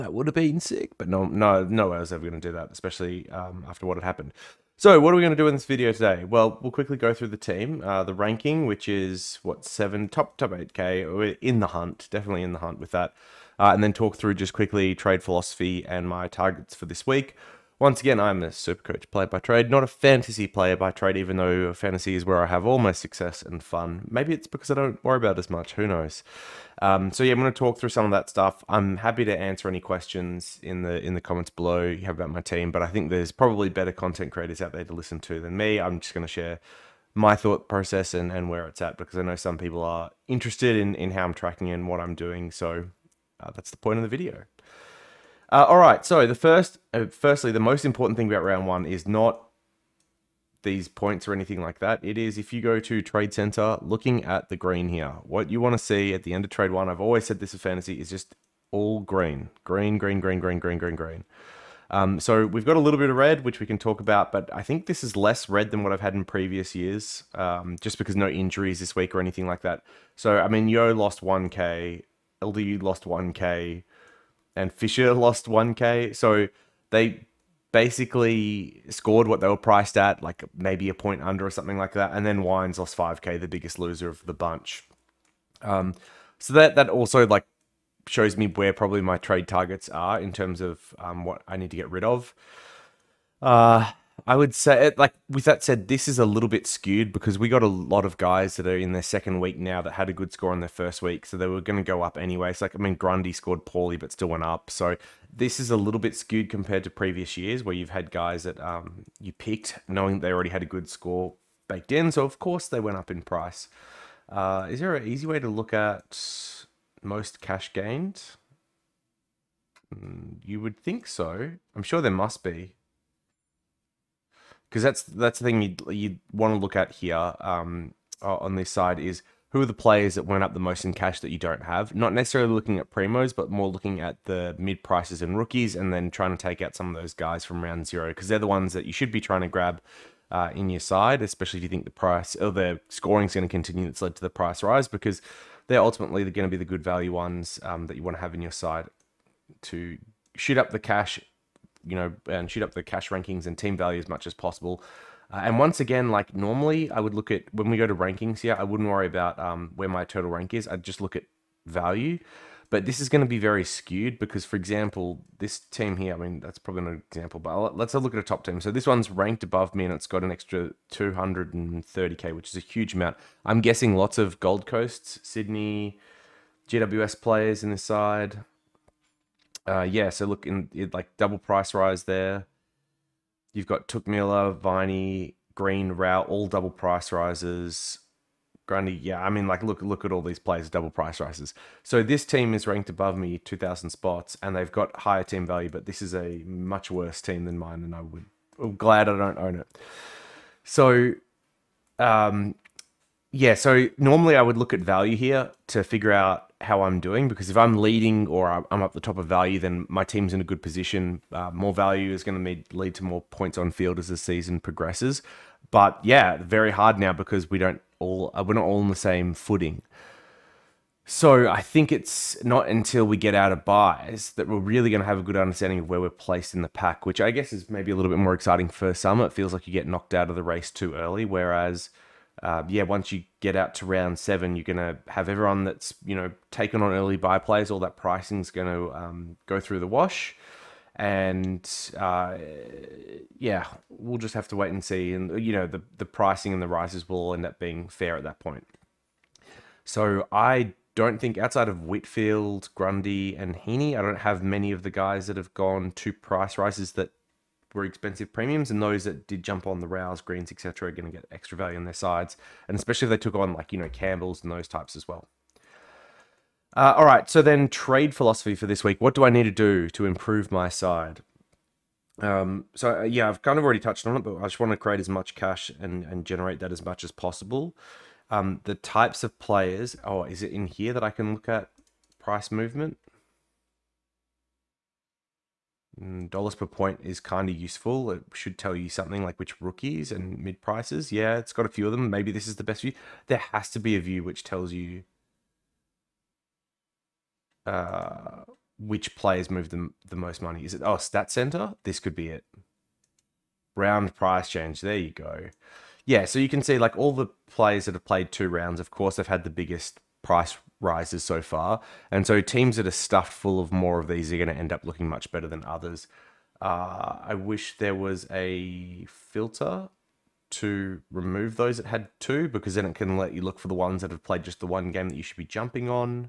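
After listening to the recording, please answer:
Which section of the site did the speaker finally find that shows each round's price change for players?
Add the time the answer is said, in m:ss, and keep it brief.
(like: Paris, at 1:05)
Stat Center, at 5:00.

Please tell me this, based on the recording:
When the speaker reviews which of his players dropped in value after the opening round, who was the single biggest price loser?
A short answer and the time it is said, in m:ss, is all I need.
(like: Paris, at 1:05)
Wines, at 1:22.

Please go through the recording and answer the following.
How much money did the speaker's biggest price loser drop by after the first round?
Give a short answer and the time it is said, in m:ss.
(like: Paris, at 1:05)
5K, at 1:22.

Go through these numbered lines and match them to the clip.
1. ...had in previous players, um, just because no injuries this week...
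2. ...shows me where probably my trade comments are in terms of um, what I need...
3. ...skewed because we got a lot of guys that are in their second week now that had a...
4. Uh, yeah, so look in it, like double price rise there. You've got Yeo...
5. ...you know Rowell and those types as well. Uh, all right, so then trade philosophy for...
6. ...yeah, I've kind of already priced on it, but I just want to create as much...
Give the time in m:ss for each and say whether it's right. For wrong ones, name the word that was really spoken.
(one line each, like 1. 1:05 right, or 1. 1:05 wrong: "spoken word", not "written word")
1. 1:05 wrong: "years", not "players"
2. 1:28 wrong: "targets", not "comments"
3. 1:36 right
4. 2:59 wrong: "Touk", not "Yeo"
5. 4:23 wrong: "Campbells", not "Rowell"
6. 4:33 wrong: "touched", not "priced".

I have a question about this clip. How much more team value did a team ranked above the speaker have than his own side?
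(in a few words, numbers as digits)
230K.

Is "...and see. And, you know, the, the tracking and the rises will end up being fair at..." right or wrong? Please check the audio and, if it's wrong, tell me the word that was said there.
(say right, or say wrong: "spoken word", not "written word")
wrong: "pricing", not "tracking".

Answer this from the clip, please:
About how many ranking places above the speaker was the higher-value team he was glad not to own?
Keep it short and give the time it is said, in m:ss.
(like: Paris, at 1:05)
2000, at 3:13.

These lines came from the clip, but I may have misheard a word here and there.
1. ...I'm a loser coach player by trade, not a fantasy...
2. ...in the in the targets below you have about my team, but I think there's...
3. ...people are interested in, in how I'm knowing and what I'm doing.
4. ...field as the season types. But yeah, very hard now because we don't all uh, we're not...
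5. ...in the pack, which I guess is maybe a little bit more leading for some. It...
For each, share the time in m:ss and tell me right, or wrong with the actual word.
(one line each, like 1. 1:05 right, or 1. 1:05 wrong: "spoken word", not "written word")
1. 0:18 wrong: "super", not "loser"
2. 0:30 wrong: "comments", not "targets"
3. 0:39 wrong: "tracking", not "knowing"
4. 3:33 wrong: "progresses", not "types"
5. 3:46 wrong: "exciting", not "leading".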